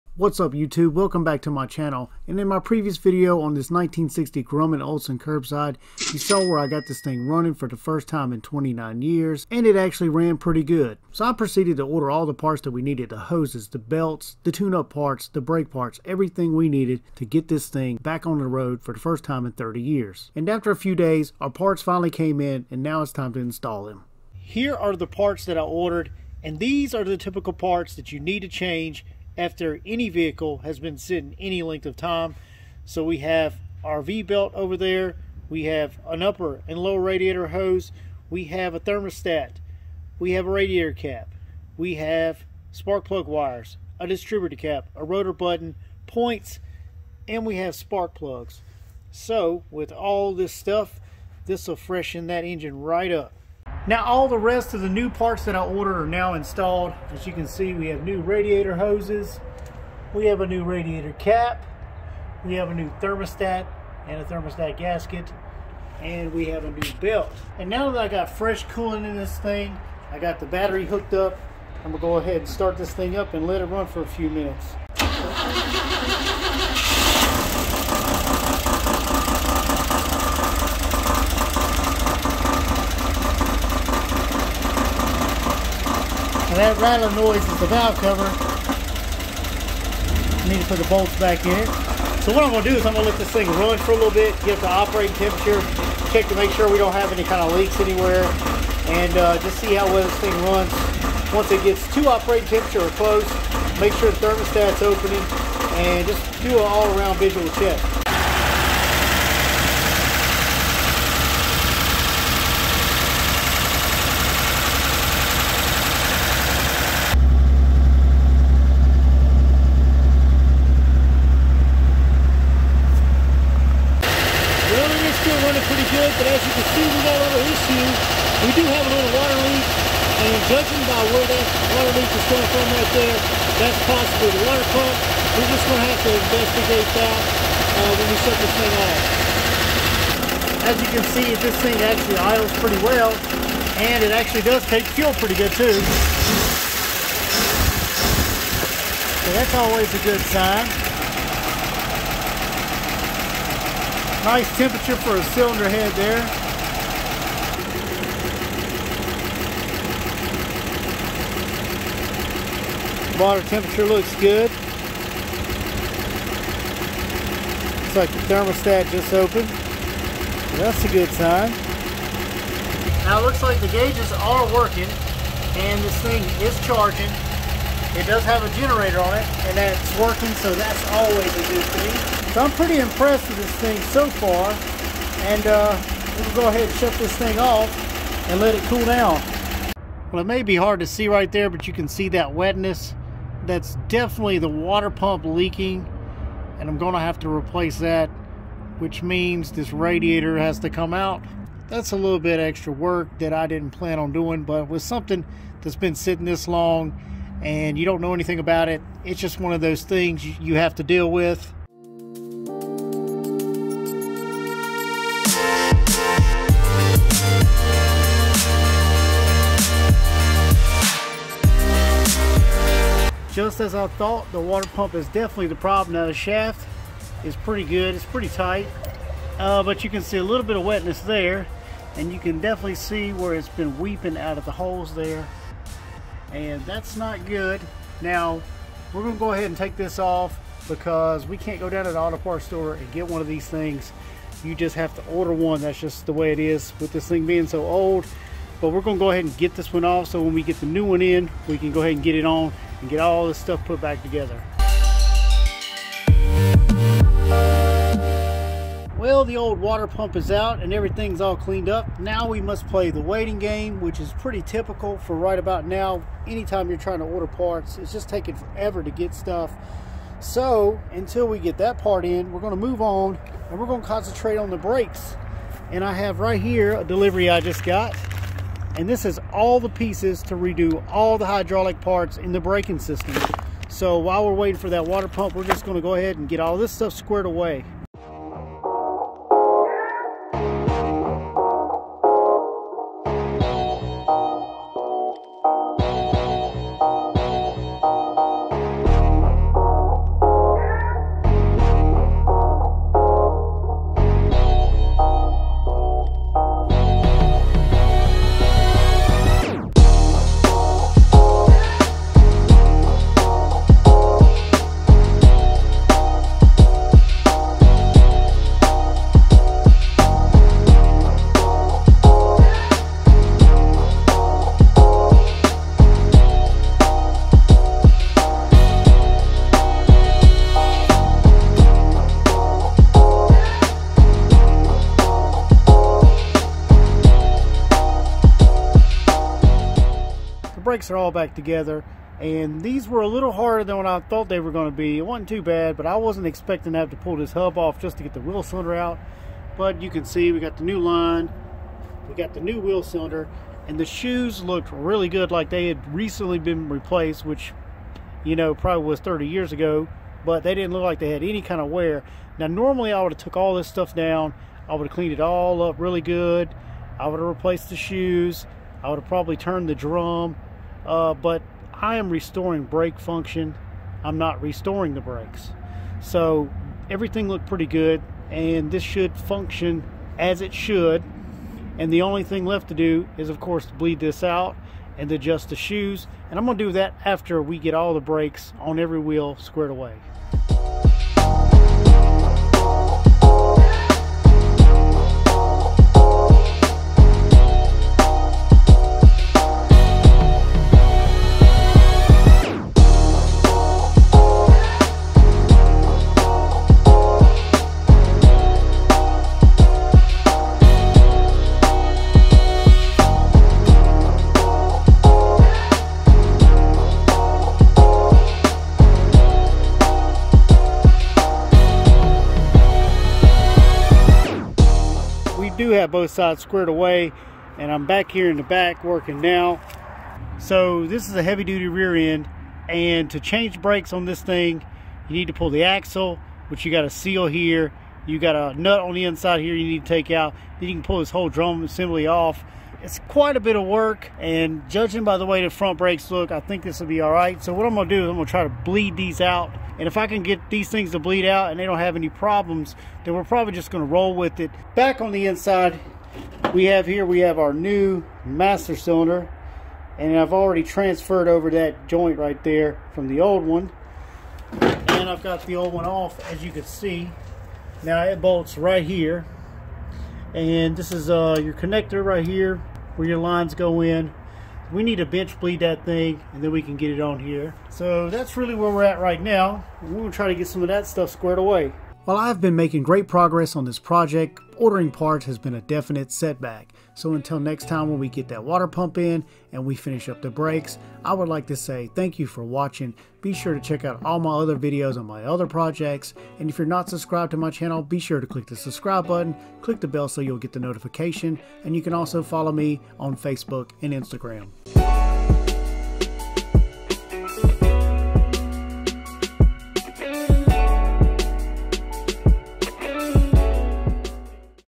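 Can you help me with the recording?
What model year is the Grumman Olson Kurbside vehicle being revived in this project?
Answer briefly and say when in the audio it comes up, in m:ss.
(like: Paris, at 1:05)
1960, at 0:03.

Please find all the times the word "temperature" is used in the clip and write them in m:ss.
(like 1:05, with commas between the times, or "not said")
1:35, 1:42, 2:34, 2:43.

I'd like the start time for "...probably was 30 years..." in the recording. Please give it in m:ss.
5:58.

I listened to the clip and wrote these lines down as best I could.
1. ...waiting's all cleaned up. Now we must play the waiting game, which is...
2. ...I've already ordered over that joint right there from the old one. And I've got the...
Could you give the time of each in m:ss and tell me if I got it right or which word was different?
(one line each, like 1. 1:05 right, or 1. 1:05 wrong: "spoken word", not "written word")
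1. 4:20 wrong: "everything", not "waiting"
2. 7:40 wrong: "transferred", not "ordered".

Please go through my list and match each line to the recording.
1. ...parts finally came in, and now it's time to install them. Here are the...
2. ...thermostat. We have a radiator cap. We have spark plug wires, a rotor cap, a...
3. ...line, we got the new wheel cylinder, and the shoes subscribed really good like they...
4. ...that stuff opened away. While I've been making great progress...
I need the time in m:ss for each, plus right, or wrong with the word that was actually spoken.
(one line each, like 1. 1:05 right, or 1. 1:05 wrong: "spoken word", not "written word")
1. 0:21 right
2. 0:38 wrong: "distributor", not "rotor"
3. 5:50 wrong: "looked", not "subscribed"
4. 8:00 wrong: "squared", not "opened".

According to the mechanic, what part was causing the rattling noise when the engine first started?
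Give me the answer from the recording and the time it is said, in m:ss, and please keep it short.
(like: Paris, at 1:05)
The valve cover, at 1:27.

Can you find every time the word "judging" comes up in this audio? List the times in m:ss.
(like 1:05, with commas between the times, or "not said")
2:10, 7:24.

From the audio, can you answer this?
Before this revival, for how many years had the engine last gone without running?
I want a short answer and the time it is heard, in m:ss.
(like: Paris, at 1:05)
29, at 0:08.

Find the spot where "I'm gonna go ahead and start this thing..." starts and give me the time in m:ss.
1:11.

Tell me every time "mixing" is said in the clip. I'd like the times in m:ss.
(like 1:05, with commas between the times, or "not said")
not said.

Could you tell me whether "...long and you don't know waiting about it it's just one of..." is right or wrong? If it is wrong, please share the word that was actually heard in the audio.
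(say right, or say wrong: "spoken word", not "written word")
wrong: "anything", not "waiting".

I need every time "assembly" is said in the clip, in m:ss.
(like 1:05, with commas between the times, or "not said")
7:21.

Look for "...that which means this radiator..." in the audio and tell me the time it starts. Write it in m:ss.
3:17.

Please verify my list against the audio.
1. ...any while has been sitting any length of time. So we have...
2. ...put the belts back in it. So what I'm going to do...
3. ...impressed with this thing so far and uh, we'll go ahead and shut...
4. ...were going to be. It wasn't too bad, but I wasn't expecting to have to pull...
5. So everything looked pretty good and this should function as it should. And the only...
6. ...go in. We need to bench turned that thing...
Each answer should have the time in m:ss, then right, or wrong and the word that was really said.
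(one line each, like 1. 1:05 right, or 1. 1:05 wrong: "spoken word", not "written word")
1. 0:29 wrong: "vehicle", not "while"
2. 1:30 wrong: "bolts", not "belts"
3. 3:02 right
4. 5:44 right
5. 6:16 right
6. 7:53 wrong: "bleed", not "turned".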